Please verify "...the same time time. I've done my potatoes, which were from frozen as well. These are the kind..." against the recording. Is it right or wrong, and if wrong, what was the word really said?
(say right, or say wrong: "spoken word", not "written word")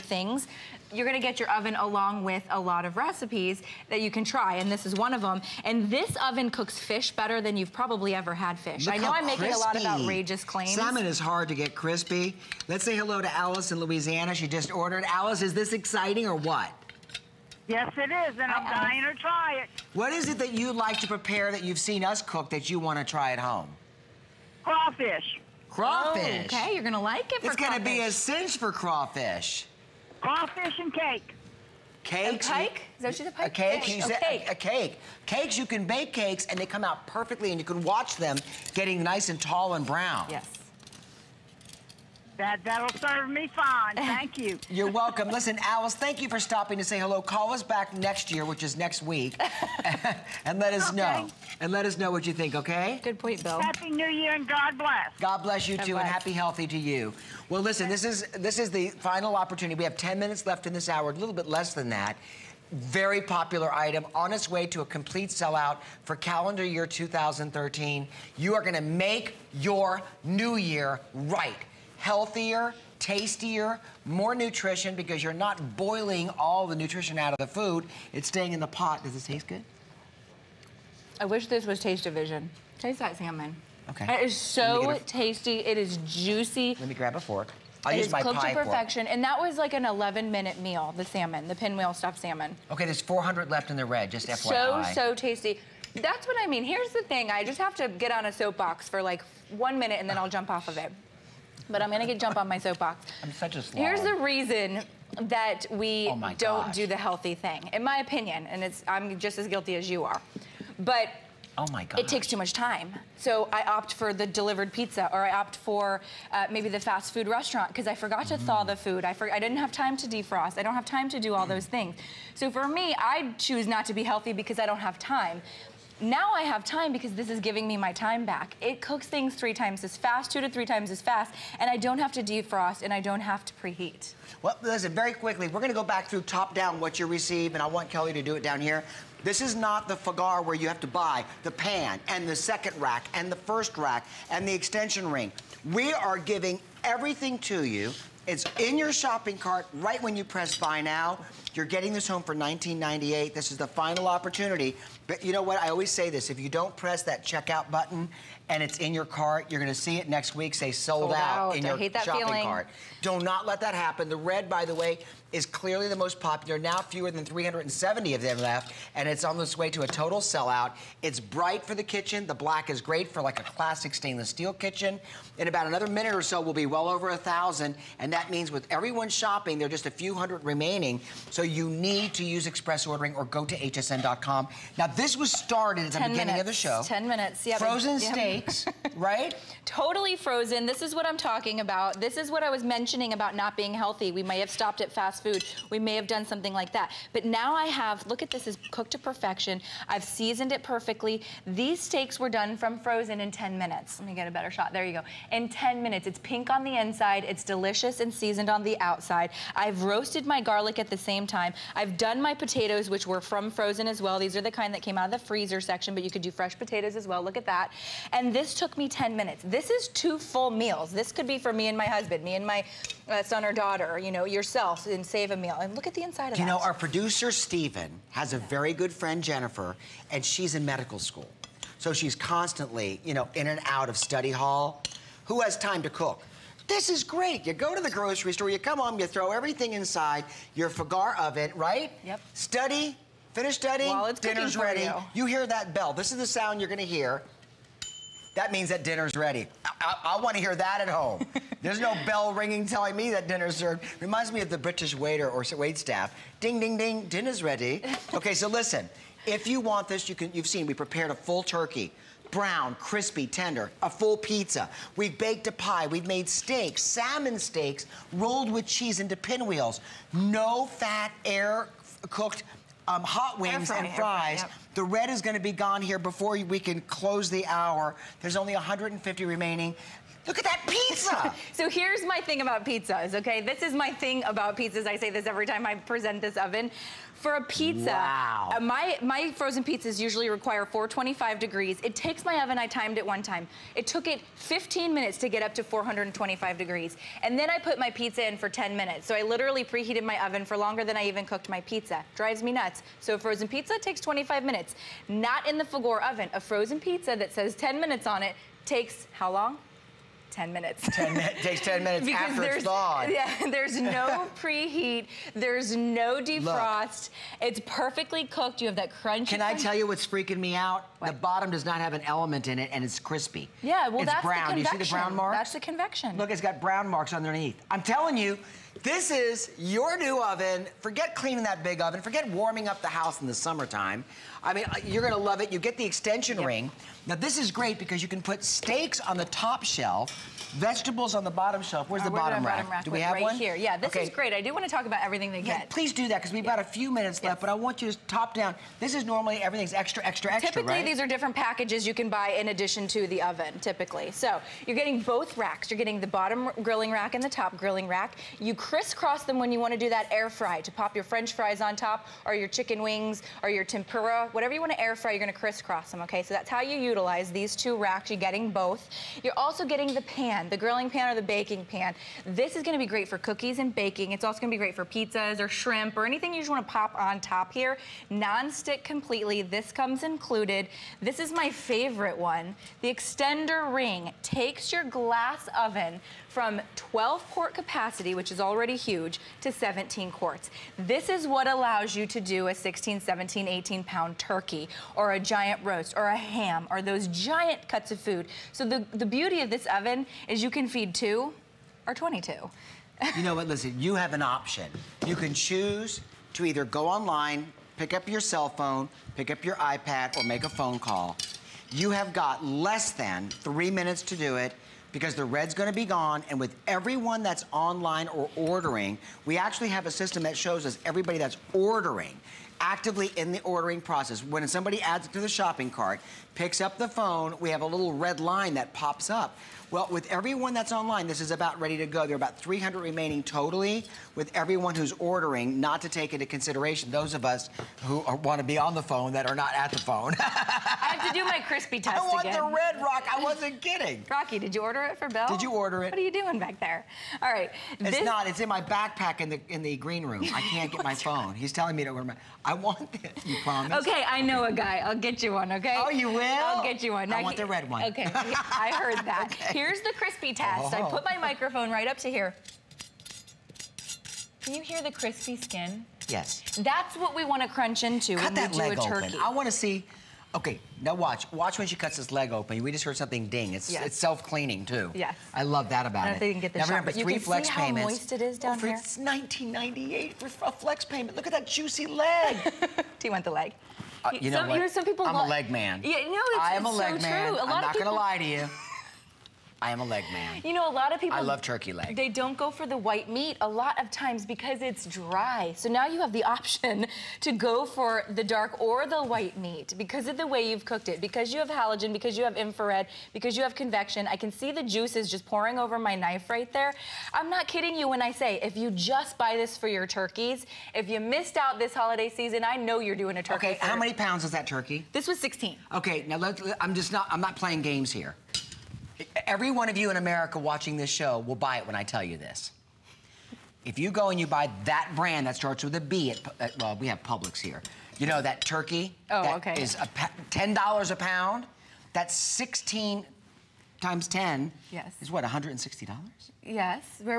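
right.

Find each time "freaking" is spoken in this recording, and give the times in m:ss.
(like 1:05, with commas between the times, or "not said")
5:20.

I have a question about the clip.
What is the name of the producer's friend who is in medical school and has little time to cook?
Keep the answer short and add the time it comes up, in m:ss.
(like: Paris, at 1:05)
Jennifer, at 3:49.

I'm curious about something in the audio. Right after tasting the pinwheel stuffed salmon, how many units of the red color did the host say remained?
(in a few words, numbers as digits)
400.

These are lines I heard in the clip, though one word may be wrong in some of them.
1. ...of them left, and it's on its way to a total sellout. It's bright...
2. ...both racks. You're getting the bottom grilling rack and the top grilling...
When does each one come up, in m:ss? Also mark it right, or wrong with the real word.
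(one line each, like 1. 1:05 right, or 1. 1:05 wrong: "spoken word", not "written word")
1. 2:48 right
2. 5:55 right.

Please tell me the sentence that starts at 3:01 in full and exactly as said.
So you need to use express ordering or go to hsn.com.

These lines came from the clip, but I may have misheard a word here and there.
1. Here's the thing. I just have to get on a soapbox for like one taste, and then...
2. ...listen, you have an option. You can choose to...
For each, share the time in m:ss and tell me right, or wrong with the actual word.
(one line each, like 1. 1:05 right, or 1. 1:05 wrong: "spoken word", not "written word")
1. 1:36 wrong: "minute", not "taste"
2. 6:43 right.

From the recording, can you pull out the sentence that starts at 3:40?
This could be for me and my husband, me and my uh, son or daughter, you know, yourself, and save a meal.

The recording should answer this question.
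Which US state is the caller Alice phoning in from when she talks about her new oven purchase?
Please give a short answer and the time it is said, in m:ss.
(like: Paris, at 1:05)
Louisiana, at 0:13.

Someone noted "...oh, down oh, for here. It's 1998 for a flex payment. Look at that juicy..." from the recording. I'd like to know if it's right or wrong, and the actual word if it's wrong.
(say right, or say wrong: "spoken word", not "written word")
right.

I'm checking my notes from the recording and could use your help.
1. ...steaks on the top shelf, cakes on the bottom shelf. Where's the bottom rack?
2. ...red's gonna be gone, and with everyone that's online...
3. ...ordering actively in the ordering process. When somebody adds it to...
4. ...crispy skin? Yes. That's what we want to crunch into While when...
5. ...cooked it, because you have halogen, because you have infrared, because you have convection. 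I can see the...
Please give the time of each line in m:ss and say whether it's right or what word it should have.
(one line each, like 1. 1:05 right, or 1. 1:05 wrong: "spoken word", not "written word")
1. 5:38 wrong: "vegetables", not "cakes"
2. 6:55 right
3. 7:01 right
4. 7:44 wrong: "Cut", not "While"
5. 8:20 right.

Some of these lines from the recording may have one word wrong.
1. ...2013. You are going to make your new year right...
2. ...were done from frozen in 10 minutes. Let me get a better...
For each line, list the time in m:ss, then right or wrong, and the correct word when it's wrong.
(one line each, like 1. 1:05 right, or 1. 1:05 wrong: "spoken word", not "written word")
1. 1:06 right
2. 3:22 right.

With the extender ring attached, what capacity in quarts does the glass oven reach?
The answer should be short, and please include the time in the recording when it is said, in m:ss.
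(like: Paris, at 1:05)
17 quarts, at 6:29.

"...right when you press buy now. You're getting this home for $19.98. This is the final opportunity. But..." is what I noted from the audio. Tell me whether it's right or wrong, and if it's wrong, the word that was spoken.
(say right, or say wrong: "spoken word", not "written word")
right.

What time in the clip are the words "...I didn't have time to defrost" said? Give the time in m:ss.
1:59.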